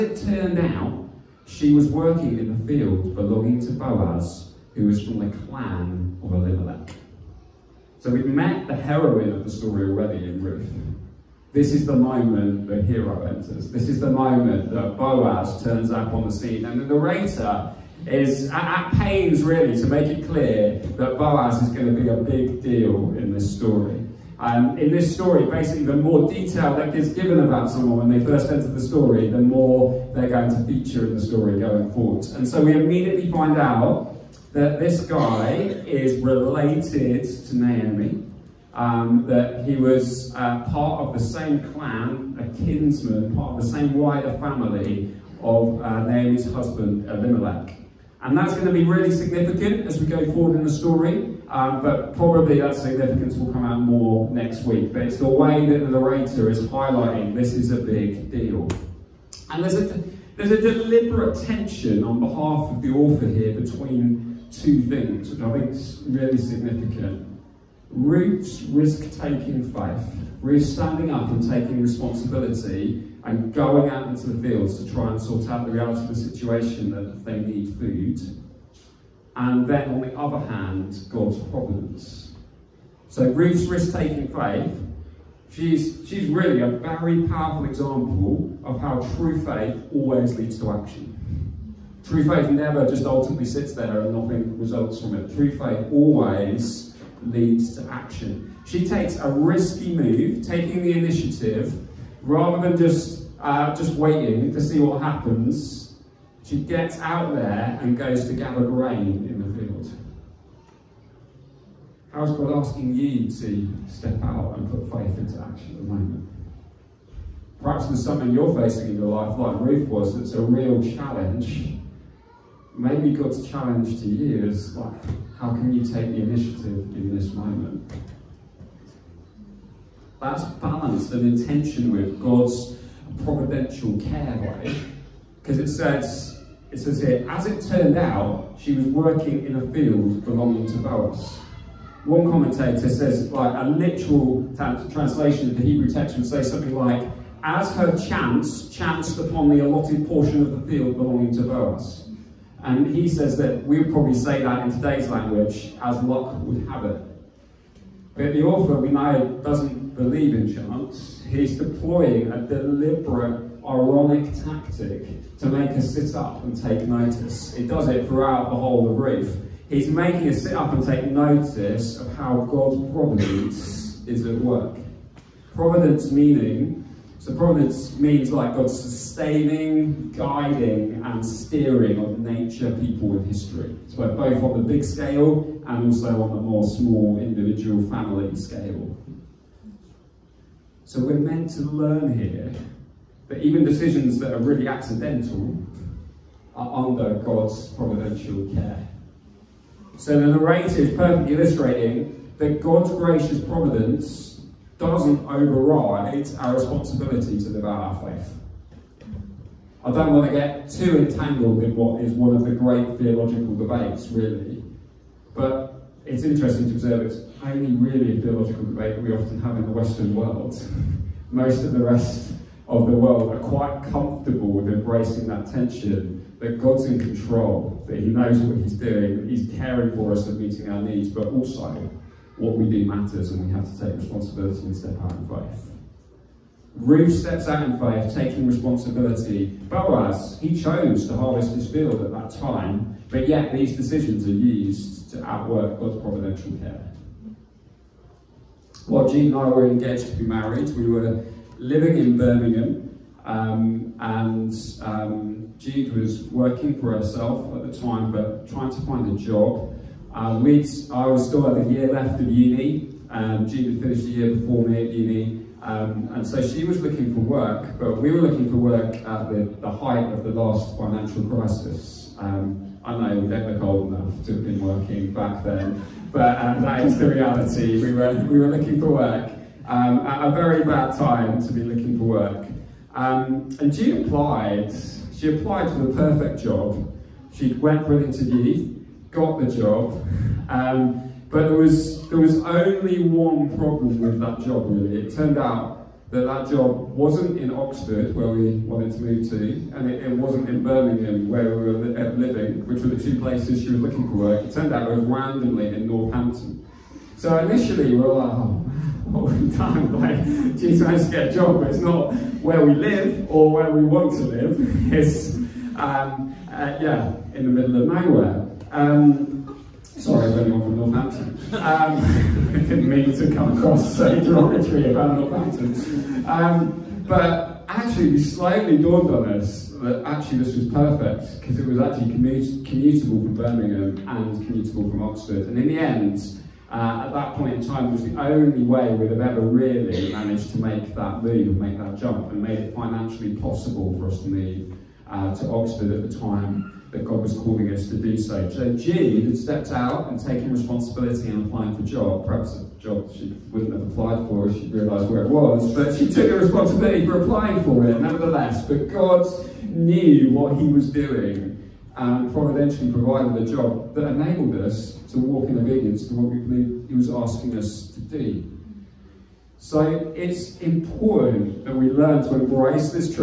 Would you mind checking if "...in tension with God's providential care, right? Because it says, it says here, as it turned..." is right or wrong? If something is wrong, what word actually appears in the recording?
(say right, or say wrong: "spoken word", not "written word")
right.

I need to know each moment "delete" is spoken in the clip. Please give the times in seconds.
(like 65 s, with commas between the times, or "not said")
not said.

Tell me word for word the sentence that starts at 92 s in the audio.
True faith never just ultimately sits there and nothing results from it.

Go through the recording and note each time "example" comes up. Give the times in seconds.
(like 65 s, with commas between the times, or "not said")
87 s.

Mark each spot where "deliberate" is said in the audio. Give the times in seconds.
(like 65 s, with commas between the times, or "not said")
60 s, 162 s.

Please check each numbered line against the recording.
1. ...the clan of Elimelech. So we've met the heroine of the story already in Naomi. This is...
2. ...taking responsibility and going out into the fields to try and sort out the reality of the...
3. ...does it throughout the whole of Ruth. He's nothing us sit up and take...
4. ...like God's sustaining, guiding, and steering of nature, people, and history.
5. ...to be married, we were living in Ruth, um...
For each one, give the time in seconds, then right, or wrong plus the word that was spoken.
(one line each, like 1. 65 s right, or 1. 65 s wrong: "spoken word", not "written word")
1. 5 s wrong: "Ruth", not "Naomi"
2. 71 s right
3. 167 s wrong: "making", not "nothing"
4. 178 s right
5. 250 s wrong: "Birmingham", not "Ruth".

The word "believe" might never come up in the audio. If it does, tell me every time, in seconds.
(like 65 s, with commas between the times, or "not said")
159 s, 366 s.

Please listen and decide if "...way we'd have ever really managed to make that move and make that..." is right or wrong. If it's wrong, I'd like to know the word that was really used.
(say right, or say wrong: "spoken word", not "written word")
right.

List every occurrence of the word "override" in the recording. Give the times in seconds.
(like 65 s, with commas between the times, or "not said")
205 s.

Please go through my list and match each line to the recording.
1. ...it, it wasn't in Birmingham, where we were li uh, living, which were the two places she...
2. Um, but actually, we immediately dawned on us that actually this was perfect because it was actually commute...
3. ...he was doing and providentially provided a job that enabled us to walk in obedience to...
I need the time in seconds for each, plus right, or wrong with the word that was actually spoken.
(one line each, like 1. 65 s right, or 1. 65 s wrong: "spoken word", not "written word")
1. 299 s right
2. 326 s wrong: "slightly", not "immediately"
3. 360 s right.